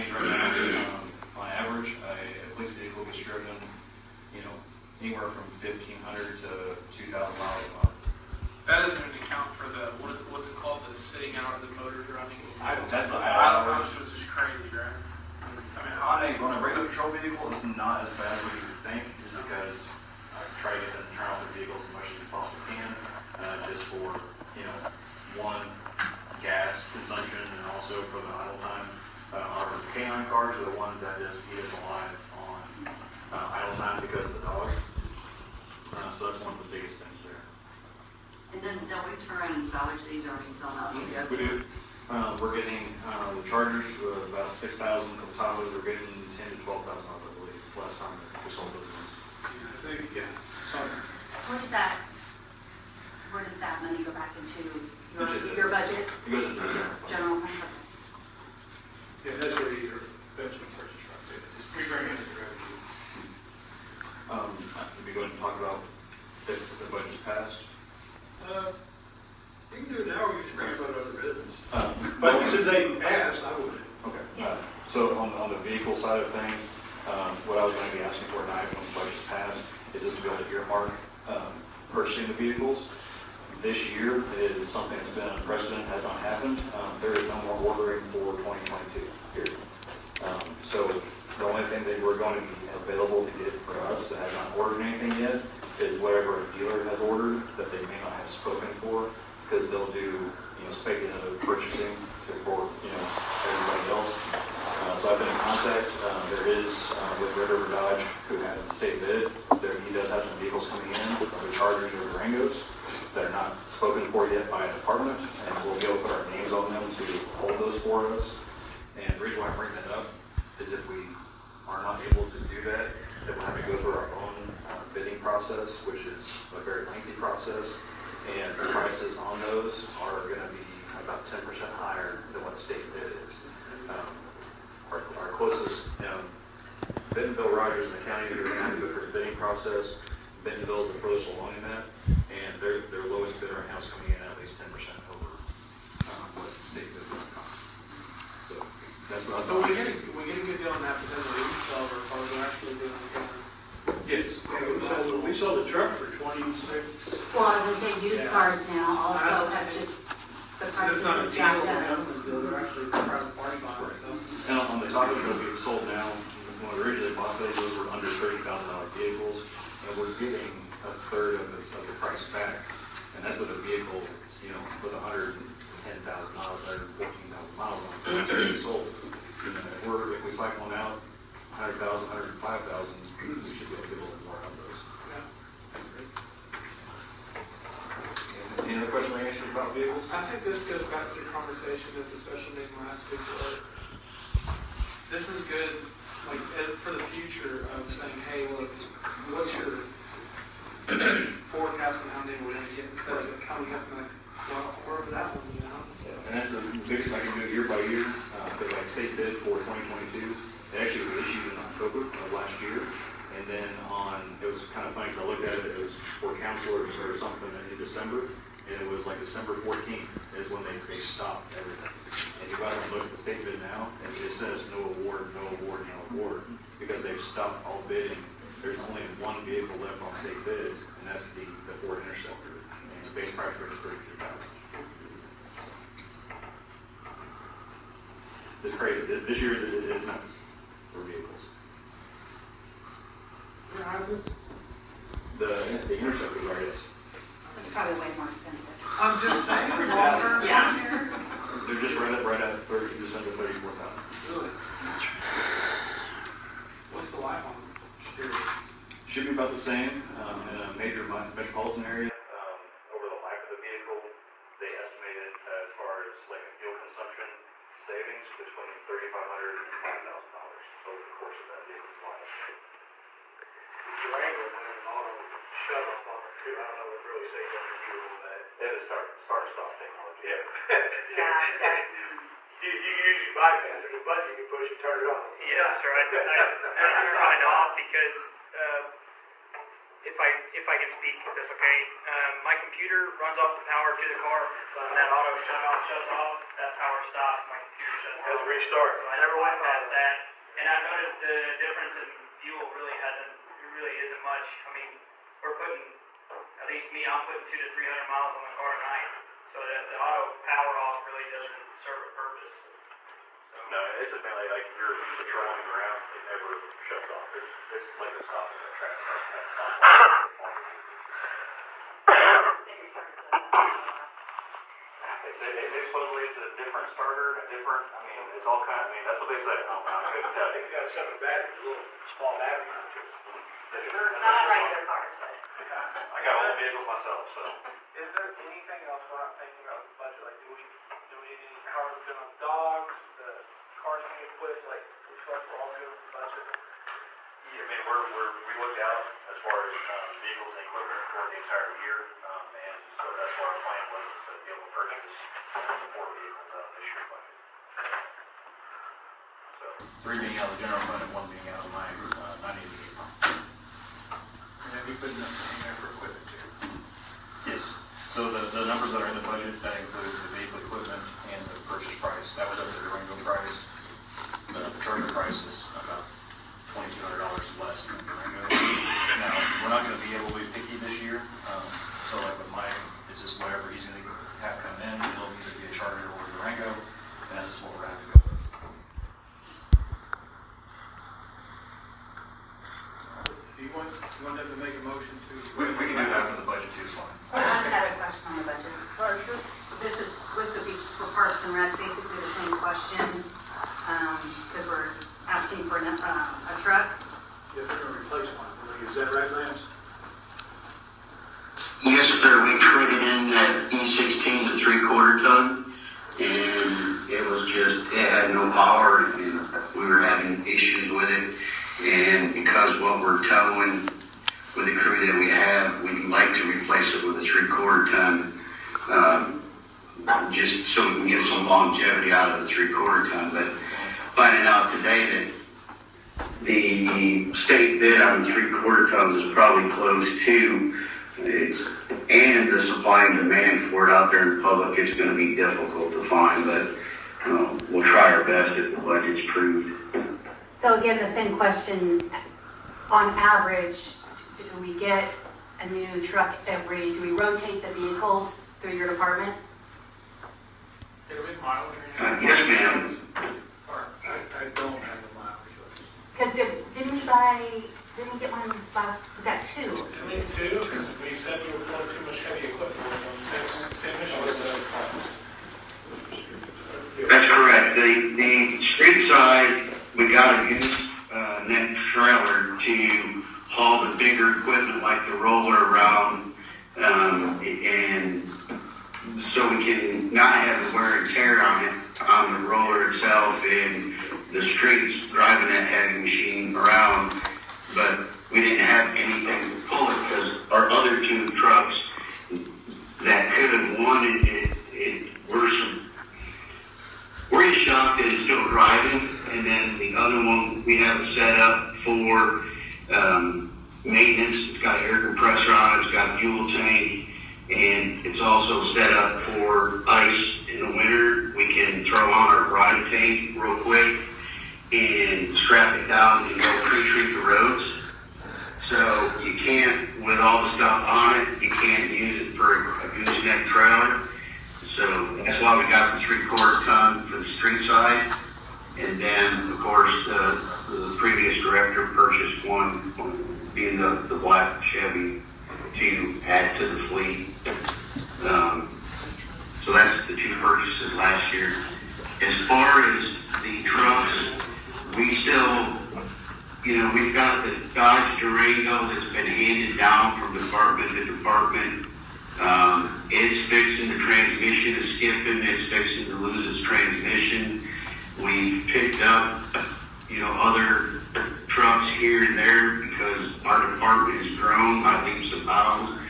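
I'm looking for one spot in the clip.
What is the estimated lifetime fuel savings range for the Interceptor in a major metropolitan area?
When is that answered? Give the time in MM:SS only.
04:28.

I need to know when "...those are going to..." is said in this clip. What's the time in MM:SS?
02:09.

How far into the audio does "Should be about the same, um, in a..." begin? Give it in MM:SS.
04:19.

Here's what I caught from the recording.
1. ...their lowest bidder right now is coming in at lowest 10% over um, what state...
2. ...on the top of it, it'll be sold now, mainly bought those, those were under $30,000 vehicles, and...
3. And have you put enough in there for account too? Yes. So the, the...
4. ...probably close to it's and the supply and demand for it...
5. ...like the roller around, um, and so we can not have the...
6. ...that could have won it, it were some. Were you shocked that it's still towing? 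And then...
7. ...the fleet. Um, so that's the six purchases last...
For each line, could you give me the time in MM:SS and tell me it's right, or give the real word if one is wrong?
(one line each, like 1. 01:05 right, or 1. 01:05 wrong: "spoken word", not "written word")
1. 02:22 wrong: "least", not "lowest"
2. 02:44 wrong: "originally", not "mainly"
3. 06:04 wrong: "equipment", not "account"
4. 07:19 right
5. 08:04 right
6. 08:23 wrong: "driving", not "towing"
7. 09:06 wrong: "two", not "six".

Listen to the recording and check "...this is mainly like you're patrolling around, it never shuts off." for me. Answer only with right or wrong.
right.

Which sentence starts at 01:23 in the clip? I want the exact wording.
This year is something that's been unprecedented, has not happened.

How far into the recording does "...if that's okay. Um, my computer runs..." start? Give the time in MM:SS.
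04:51.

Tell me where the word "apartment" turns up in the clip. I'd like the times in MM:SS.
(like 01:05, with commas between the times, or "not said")
not said.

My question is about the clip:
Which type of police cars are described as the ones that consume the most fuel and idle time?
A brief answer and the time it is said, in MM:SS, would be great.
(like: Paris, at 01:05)
Canine cars, at 00:29.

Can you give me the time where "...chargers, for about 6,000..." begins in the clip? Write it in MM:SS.
00:43.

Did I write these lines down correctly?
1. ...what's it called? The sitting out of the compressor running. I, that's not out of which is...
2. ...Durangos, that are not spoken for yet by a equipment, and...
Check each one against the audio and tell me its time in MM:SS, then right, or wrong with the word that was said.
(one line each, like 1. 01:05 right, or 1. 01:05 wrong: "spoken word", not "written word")
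1. 00:10 wrong: "motor", not "compressor"
2. 01:52 wrong: "department", not "equipment".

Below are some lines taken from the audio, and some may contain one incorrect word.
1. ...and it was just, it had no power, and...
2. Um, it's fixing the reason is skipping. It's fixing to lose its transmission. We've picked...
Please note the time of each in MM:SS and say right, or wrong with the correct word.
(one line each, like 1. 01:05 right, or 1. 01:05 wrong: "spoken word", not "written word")
1. 06:56 right
2. 09:22 wrong: "transmission", not "reason".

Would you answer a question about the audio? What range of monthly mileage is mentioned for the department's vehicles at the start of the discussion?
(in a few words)
1,500 to 2,000 miles.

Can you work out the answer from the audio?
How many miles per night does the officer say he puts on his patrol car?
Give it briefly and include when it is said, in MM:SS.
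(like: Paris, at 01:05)
200 to 300, at 05:07.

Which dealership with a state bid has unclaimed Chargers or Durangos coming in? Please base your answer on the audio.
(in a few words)
River Dodge.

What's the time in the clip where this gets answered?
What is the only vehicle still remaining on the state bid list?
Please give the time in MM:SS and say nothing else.
03:51.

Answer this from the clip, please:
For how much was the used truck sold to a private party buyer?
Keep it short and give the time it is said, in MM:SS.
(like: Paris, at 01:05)
26,000, at 02:36.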